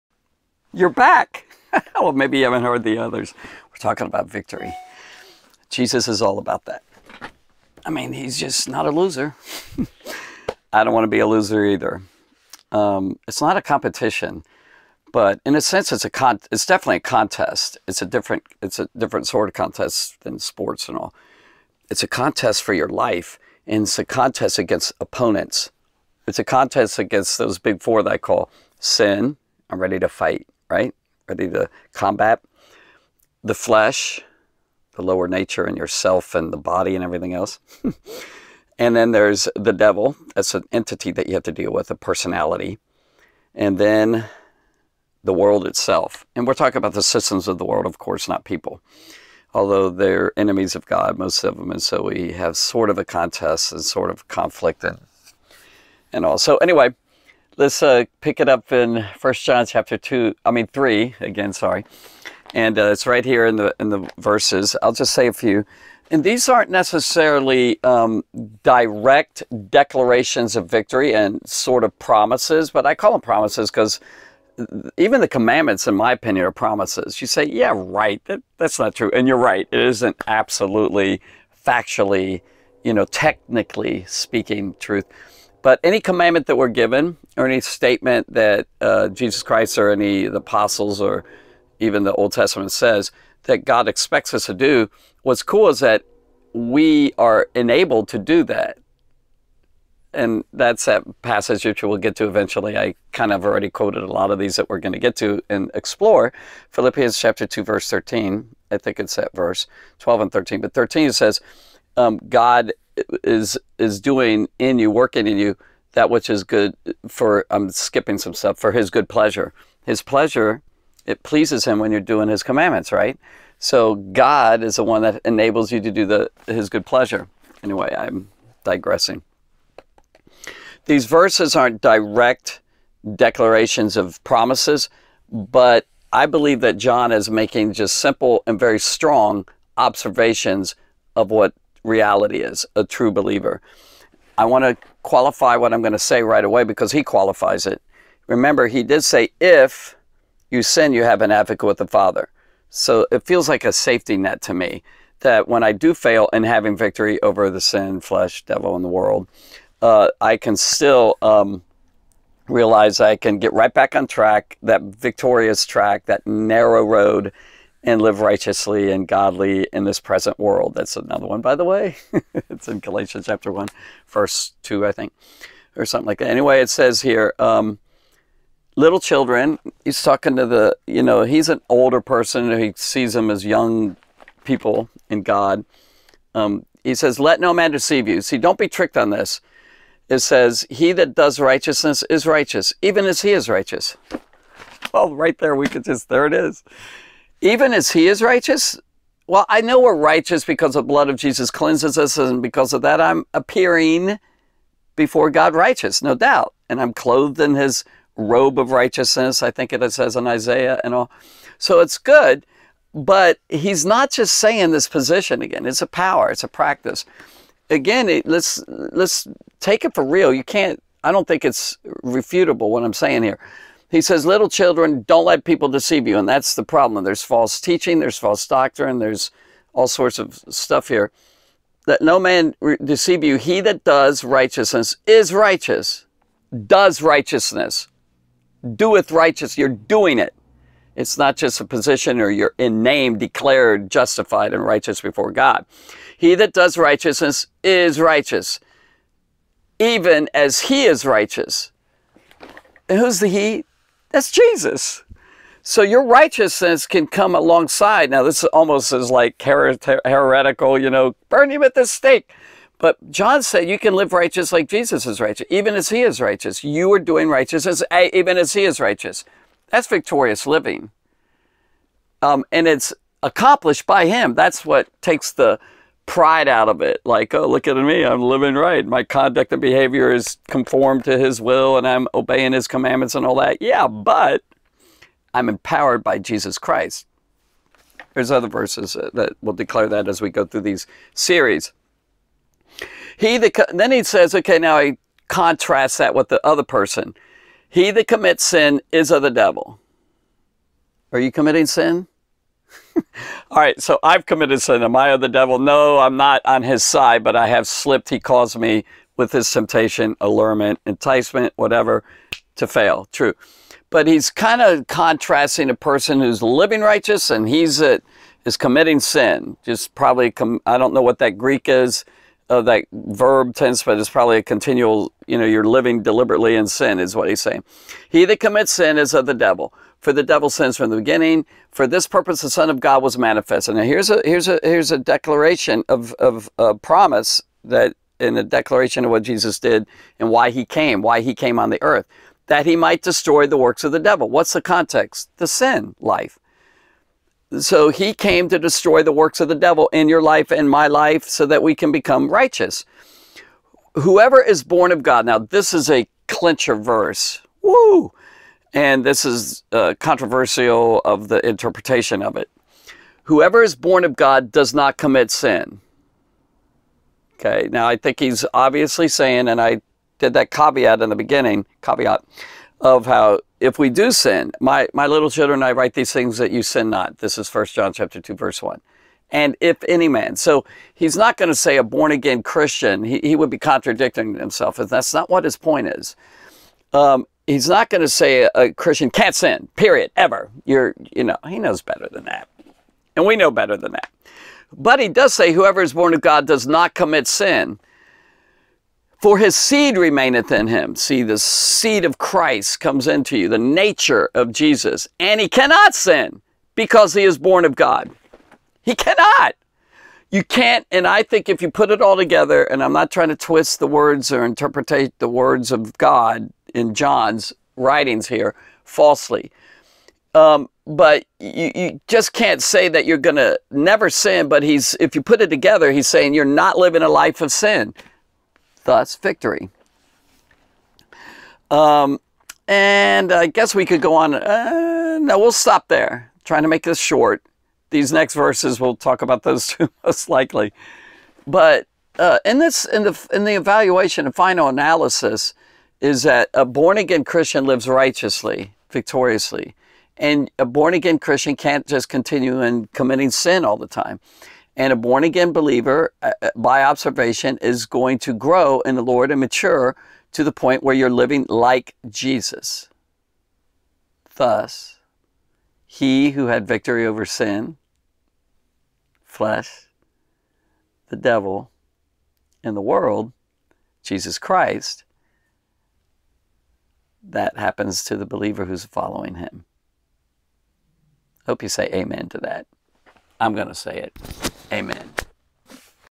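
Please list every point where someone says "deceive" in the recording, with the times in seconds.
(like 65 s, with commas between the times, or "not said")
187 s, 225 s, 232 s.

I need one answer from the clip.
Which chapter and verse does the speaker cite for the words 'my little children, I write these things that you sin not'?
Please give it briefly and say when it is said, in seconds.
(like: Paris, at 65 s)
First John 2:1, at 377 s.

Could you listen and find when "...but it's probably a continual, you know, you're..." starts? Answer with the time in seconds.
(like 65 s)
323 s.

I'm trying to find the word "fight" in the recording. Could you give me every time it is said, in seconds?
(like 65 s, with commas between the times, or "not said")
30 s.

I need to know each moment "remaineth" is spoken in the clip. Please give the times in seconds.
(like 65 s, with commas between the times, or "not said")
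399 s.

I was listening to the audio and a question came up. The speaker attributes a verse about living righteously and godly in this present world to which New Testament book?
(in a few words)
Galatians.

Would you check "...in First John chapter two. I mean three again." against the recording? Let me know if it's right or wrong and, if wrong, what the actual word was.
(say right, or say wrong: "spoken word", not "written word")
right.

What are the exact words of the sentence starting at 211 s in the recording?
So it's good, but he's not just saying this position again.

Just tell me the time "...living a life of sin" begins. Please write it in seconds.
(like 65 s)
426 s.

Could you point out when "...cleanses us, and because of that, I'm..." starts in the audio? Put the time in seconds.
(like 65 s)
201 s.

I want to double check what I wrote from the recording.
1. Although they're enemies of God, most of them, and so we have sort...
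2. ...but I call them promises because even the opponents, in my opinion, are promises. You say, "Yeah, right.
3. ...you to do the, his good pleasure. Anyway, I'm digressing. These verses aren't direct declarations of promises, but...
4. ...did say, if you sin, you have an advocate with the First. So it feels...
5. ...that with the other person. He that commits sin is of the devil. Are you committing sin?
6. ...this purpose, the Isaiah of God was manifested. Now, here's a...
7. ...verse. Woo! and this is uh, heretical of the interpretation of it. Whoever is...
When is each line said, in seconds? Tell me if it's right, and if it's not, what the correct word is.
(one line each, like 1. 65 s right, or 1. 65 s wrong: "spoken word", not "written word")
1. 49 s right
2. 72 s wrong: "commandments", not "opponents"
3. 125 s right
4. 148 s wrong: "Father", not "First"
5. 295 s right
6. 331 s wrong: "Son", not "Isaiah"
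7. 356 s wrong: "controversial", not "heretical".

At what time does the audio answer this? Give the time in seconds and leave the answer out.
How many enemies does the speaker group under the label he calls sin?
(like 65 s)
27 s.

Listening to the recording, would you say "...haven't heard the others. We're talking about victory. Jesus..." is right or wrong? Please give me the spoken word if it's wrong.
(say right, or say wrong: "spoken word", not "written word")
right.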